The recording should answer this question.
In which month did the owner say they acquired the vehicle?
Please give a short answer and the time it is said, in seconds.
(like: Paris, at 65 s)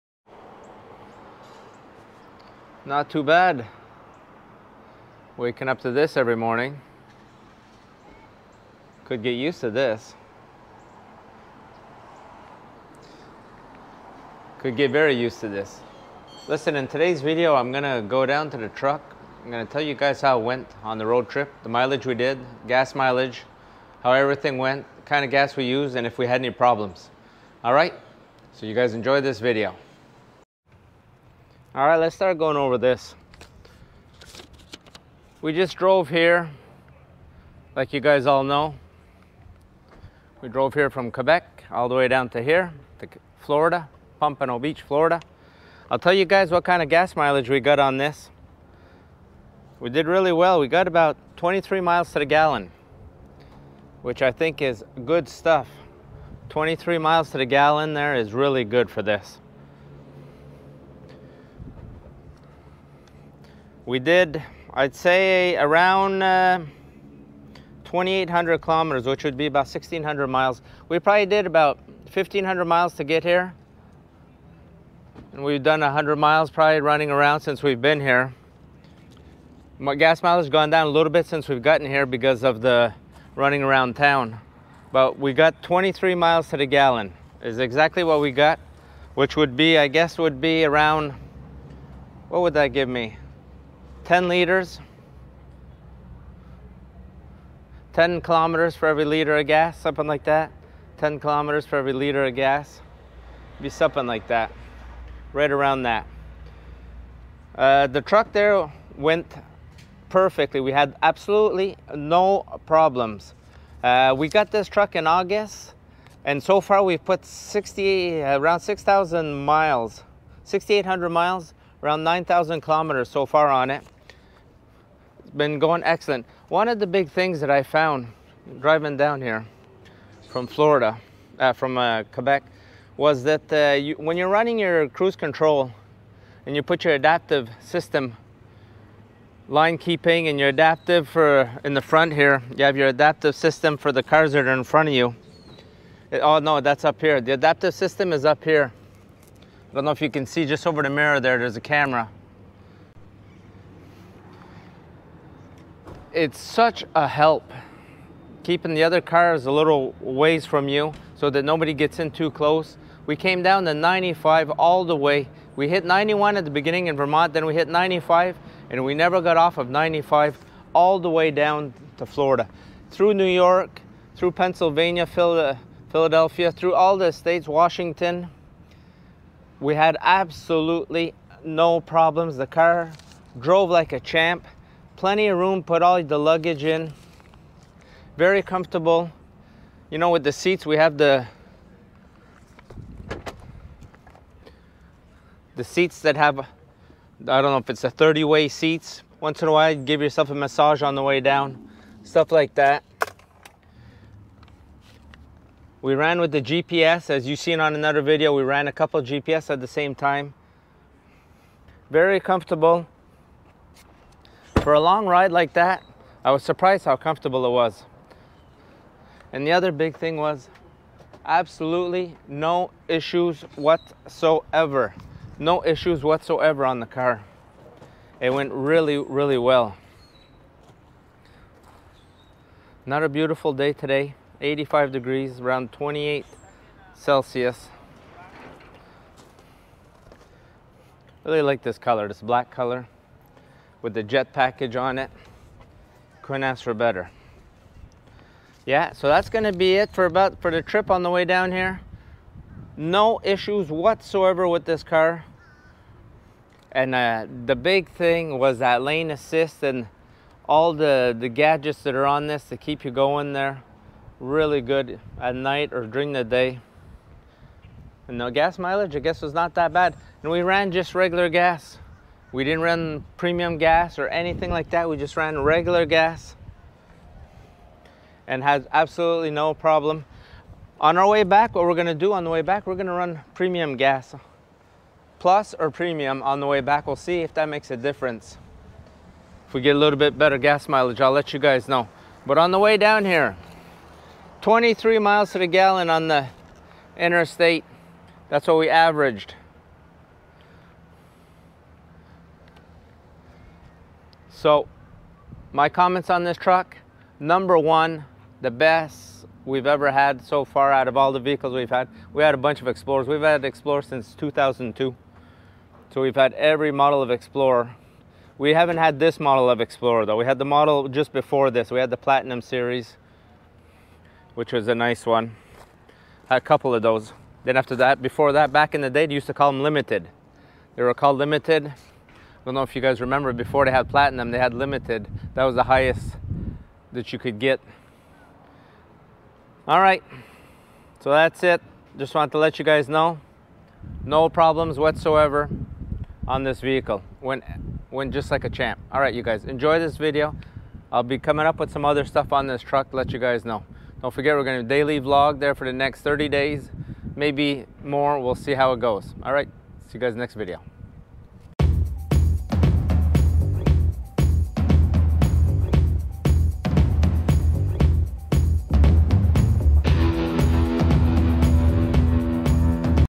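August, at 115 s.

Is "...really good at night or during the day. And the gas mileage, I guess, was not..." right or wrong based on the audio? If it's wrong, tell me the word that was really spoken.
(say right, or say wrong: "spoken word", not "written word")
right.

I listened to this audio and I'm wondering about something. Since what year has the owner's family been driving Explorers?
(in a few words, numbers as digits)
2002.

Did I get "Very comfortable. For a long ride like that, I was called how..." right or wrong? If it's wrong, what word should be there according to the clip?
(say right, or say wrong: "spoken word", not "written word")
wrong: "surprised", not "called".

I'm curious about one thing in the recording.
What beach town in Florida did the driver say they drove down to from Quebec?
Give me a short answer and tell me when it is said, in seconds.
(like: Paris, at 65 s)
Pompano Beach, at 44 s.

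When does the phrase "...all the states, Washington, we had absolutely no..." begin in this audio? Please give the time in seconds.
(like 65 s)
176 s.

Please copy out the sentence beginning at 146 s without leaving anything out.
It, oh no, that's up here.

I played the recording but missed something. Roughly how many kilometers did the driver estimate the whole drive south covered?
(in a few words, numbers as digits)
2,800.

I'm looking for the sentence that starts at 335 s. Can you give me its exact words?
That was the highest that you could get.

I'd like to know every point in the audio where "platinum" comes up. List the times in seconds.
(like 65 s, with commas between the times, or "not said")
321 s, 333 s.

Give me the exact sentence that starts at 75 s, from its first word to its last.
And we've done 100 miles probably running around since we've been here.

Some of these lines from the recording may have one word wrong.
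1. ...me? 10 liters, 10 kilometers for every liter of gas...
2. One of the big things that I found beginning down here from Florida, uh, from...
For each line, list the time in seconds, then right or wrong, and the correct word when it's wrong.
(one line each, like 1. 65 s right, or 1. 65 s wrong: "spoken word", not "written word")
1. 92 s right
2. 126 s wrong: "driving", not "beginning".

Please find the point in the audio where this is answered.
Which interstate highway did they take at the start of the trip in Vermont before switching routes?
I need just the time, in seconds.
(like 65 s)
165 s.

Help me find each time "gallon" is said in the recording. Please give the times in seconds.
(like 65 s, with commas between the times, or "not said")
52 s, 57 s, 86 s, 295 s.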